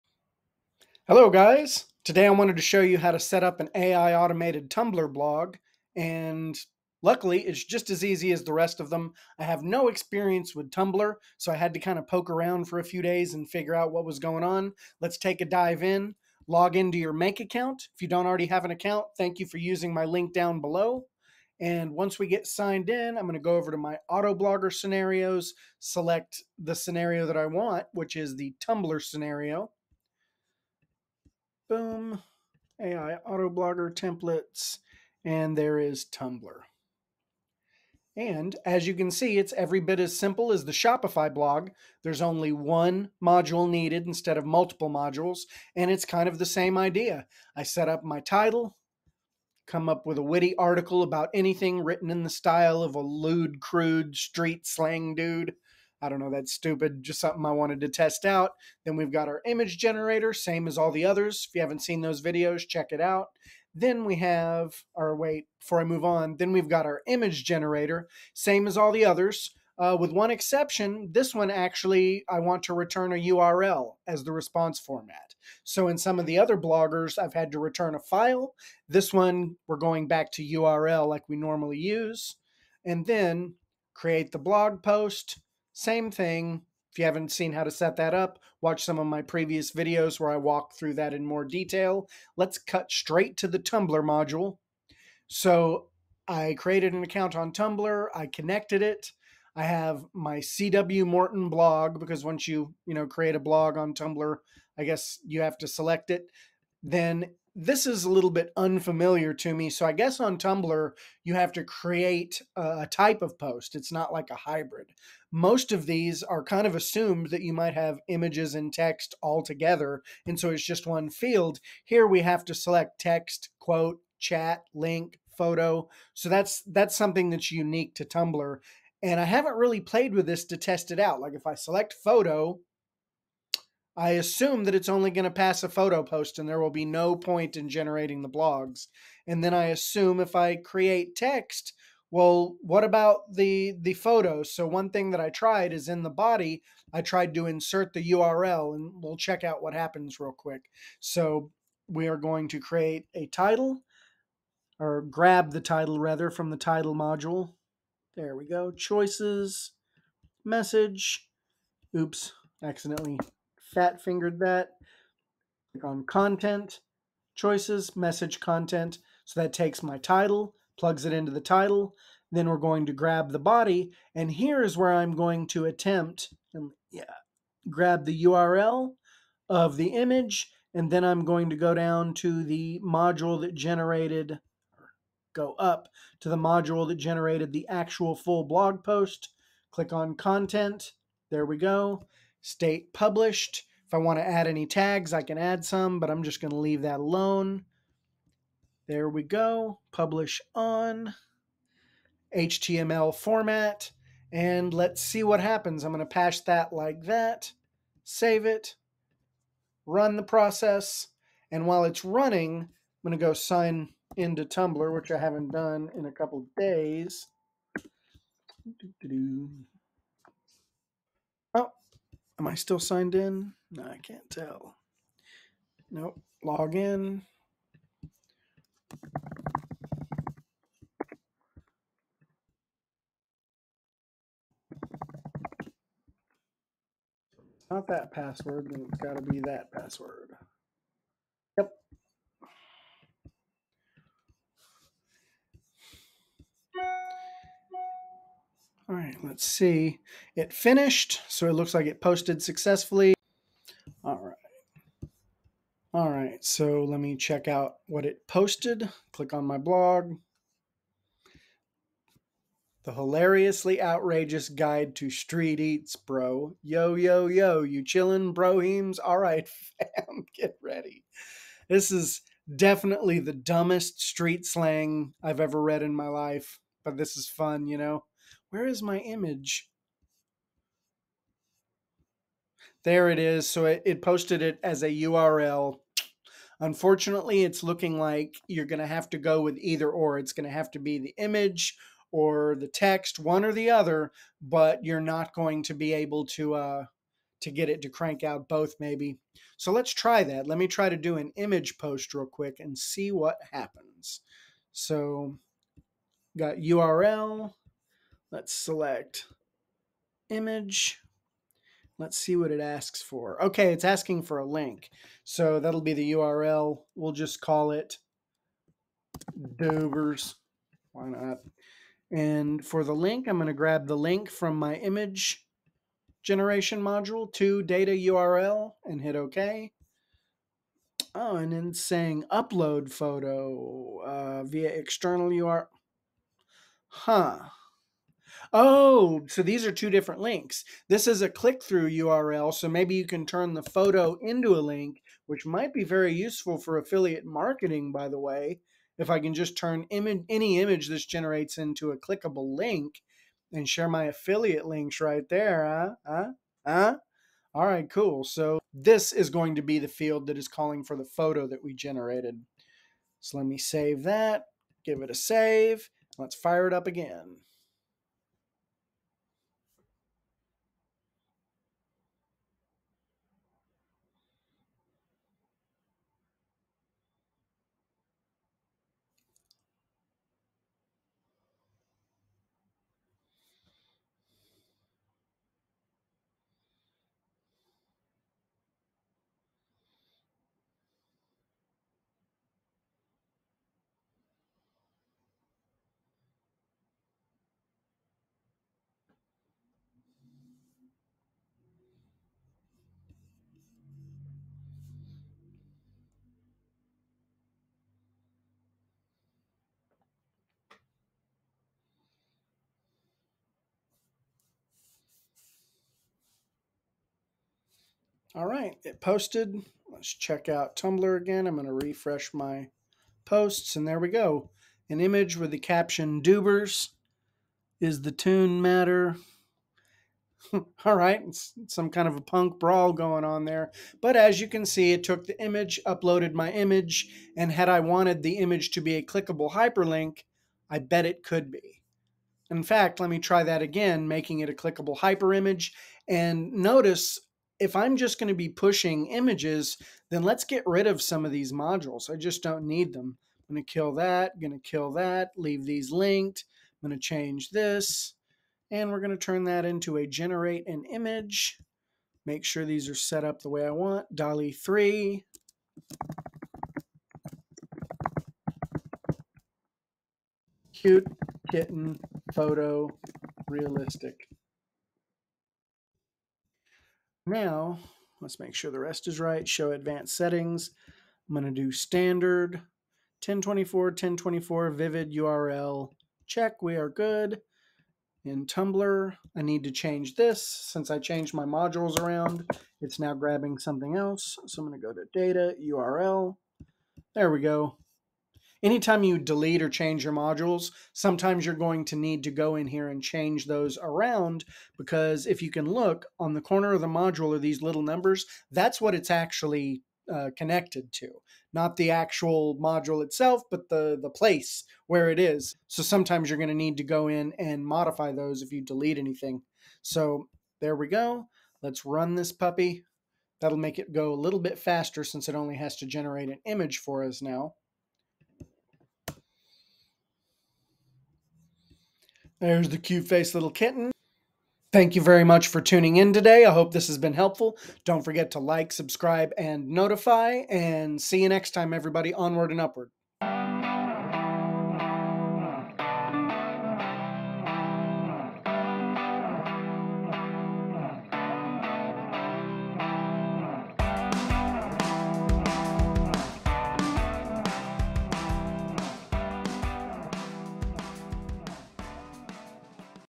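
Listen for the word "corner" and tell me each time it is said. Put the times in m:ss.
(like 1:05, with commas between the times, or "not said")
8:26.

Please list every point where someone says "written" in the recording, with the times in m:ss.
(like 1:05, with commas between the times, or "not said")
0:51.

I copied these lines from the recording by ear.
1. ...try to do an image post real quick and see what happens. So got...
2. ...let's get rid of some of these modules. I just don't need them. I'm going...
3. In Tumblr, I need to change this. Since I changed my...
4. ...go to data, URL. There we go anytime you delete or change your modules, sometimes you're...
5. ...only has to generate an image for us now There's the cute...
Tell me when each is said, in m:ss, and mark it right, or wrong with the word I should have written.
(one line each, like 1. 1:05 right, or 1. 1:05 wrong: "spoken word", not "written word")
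1. 5:00 right
2. 7:30 right
3. 8:08 right
4. 8:14 right
5. 8:45 right.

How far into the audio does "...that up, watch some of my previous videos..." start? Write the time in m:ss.
1:27.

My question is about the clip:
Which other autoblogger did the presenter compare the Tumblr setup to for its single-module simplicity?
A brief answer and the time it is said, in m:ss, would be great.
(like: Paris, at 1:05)
Shopify, at 0:40.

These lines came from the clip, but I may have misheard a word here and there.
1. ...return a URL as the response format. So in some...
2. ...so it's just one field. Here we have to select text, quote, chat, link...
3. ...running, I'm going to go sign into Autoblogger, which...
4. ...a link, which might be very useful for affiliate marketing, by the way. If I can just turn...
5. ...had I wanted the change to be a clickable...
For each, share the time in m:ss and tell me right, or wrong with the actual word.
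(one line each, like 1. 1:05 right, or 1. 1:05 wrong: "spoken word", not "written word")
1. 1:12 right
2. 2:00 right
3. 3:32 wrong: "Tumblr", not "Autoblogger"
4. 5:44 right
5. 7:17 wrong: "image", not "change".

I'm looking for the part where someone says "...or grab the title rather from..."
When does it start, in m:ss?
2:34.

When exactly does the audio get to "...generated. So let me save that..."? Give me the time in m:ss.
6:01.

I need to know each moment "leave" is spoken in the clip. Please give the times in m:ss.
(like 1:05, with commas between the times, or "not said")
3:16, 7:35.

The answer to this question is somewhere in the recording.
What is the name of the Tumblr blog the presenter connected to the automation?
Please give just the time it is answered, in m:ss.
1:40.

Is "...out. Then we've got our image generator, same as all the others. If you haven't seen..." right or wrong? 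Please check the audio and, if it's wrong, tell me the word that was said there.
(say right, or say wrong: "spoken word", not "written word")
right.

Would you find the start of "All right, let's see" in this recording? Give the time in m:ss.
4:08.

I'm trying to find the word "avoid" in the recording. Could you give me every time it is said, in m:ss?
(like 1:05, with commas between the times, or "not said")
not said.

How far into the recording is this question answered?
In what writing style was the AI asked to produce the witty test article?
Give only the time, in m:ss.
0:52.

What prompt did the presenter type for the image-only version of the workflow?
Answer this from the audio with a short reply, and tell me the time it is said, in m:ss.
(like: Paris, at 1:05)
Cute kitten photo realistic, at 7:50.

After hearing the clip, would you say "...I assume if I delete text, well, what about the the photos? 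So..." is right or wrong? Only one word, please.
wrong.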